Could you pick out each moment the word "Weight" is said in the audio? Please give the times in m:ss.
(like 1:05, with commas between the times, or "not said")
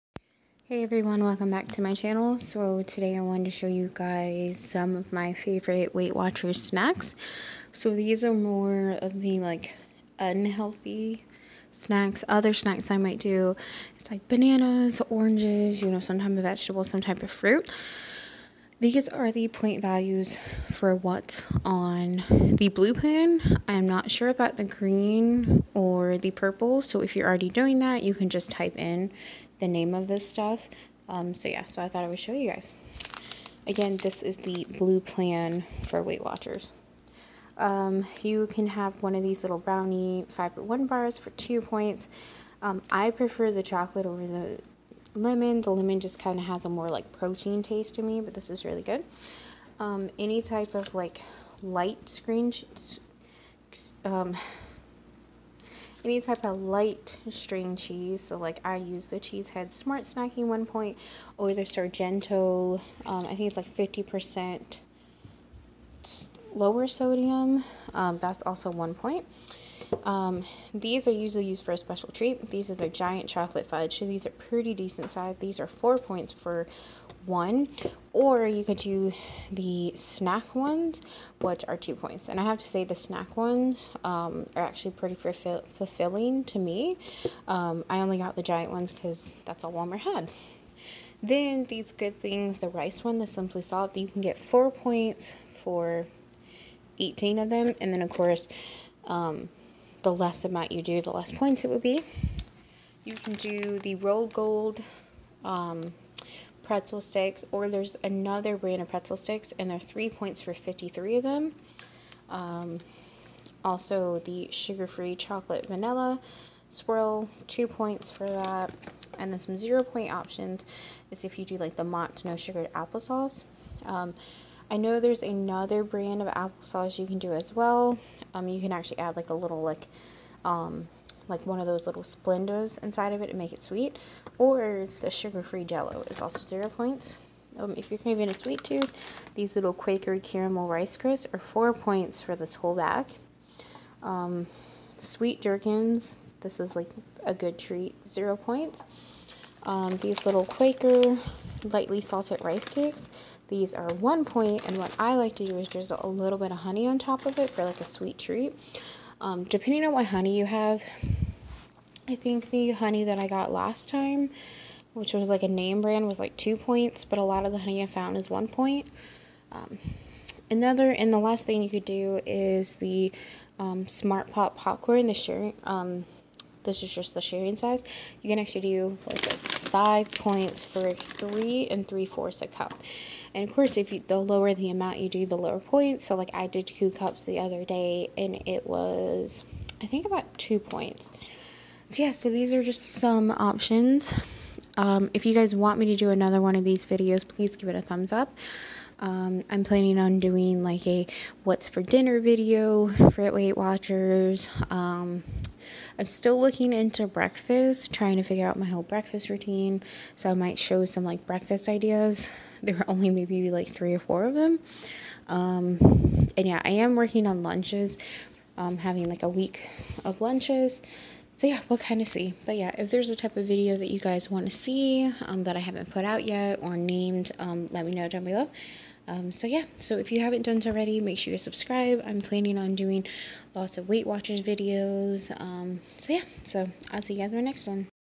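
0:05, 0:36, 3:23, 3:53.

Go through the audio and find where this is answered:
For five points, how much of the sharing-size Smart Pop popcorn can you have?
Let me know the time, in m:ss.
3:00.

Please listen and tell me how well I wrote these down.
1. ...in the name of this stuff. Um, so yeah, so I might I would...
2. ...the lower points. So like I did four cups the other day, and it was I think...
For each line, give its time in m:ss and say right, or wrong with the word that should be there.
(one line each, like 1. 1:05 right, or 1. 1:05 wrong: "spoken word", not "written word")
1. 0:28 wrong: "thought", not "might"
2. 3:05 wrong: "two", not "four".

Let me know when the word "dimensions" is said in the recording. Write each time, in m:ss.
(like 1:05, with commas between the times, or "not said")
not said.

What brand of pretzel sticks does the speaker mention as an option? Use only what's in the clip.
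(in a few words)
Rold Gold.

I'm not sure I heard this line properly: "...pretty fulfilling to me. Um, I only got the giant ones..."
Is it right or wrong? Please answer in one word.
right.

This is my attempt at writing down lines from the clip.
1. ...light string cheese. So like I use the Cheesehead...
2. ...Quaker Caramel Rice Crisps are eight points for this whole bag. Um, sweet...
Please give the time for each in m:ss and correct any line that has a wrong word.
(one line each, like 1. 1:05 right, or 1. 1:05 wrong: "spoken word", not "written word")
1. 0:56 right
2. 2:19 wrong: "four", not "eight".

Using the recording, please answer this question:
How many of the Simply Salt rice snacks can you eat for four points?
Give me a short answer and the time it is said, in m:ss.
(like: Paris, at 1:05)
18, at 1:36.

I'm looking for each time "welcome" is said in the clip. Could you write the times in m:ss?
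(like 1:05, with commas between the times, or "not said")
0:01.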